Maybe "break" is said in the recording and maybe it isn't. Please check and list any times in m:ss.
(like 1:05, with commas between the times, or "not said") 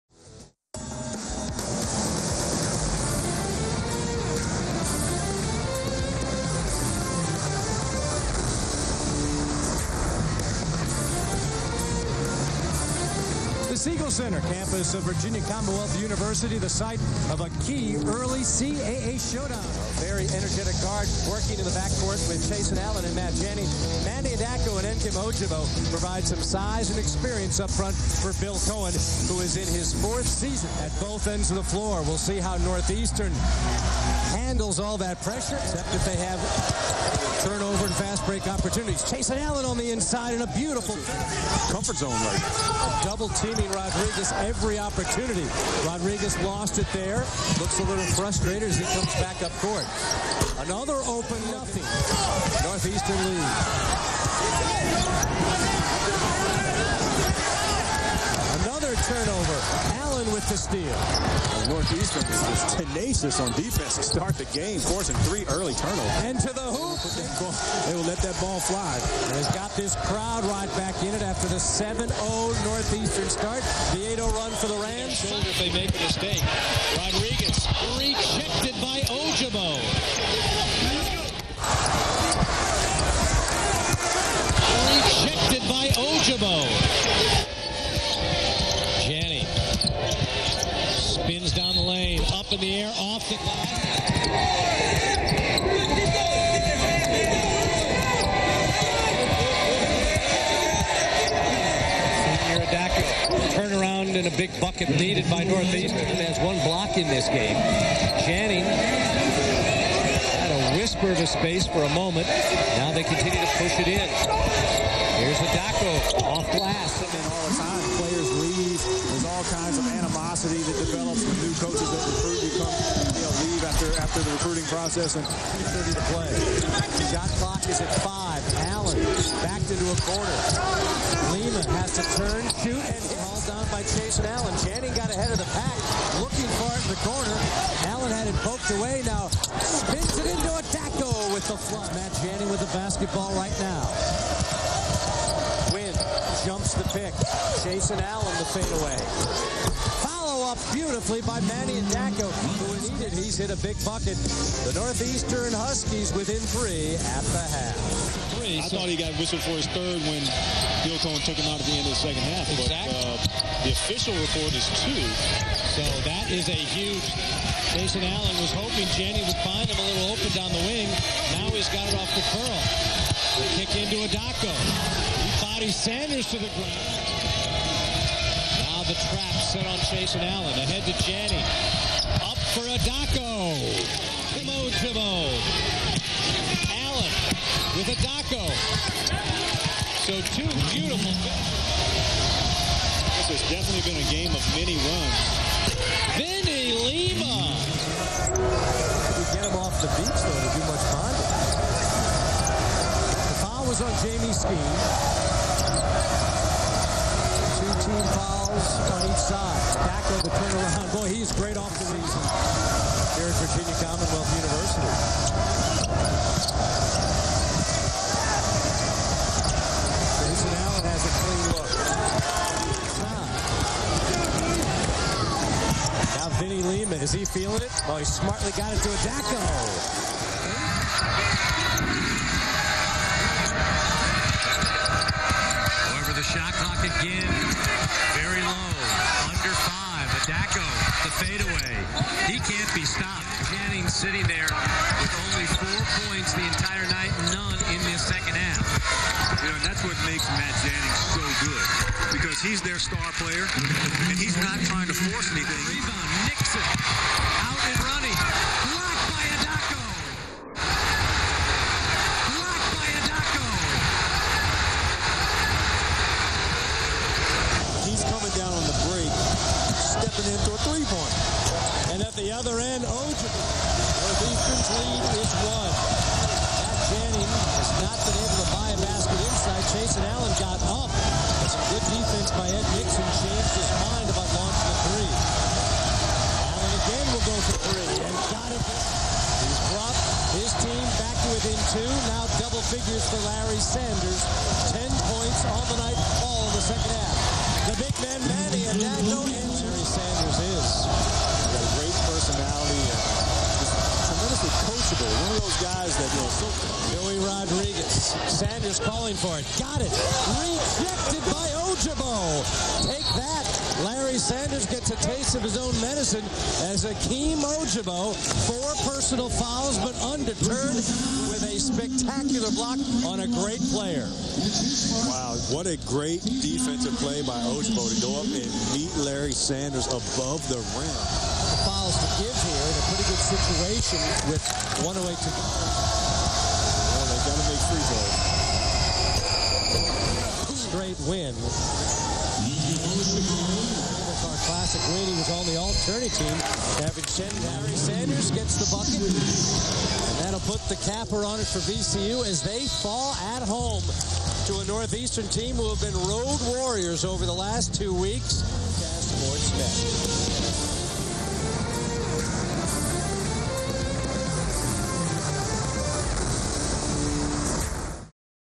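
0:38, 4:28.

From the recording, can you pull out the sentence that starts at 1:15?
If they make a mistake, Rodriguez rejected by Ojougboh.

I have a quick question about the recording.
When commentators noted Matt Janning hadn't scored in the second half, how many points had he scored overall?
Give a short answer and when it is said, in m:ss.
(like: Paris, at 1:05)
4, at 4:05.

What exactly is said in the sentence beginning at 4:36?
Jack Janning has not been able to buy a basket inside.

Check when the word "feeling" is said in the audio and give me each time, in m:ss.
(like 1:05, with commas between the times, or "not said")
3:47.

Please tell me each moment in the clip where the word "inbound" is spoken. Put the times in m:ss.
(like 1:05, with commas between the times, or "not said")
not said.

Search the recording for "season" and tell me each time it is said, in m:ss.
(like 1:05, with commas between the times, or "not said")
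0:30, 3:31.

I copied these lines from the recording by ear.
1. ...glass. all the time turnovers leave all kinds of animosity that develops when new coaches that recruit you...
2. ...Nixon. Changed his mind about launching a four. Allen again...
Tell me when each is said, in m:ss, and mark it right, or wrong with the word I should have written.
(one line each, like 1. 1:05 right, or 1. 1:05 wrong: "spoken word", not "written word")
1. 1:56 wrong: "players", not "turnovers"
2. 4:42 wrong: "three", not "four".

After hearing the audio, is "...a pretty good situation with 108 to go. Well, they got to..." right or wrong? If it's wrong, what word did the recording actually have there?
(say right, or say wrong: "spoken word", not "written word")
right.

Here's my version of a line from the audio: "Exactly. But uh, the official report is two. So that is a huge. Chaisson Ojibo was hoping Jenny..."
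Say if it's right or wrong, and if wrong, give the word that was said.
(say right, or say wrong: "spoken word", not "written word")
wrong: "Allen", not "Ojibo".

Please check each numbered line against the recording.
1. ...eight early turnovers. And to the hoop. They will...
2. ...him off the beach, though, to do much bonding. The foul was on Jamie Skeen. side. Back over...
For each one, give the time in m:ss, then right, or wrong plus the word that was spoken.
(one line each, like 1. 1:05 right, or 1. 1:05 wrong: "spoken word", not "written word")
1. 1:05 wrong: "three", not "eight"
2. 3:19 right.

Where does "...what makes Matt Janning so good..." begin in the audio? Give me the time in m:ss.
4:09.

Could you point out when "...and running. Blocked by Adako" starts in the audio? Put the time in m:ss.
4:17.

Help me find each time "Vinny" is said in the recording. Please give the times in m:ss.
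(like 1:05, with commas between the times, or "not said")
3:16, 3:46.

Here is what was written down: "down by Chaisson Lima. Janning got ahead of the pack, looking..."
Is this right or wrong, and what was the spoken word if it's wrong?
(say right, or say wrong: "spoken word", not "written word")
wrong: "Allen", not "Lima".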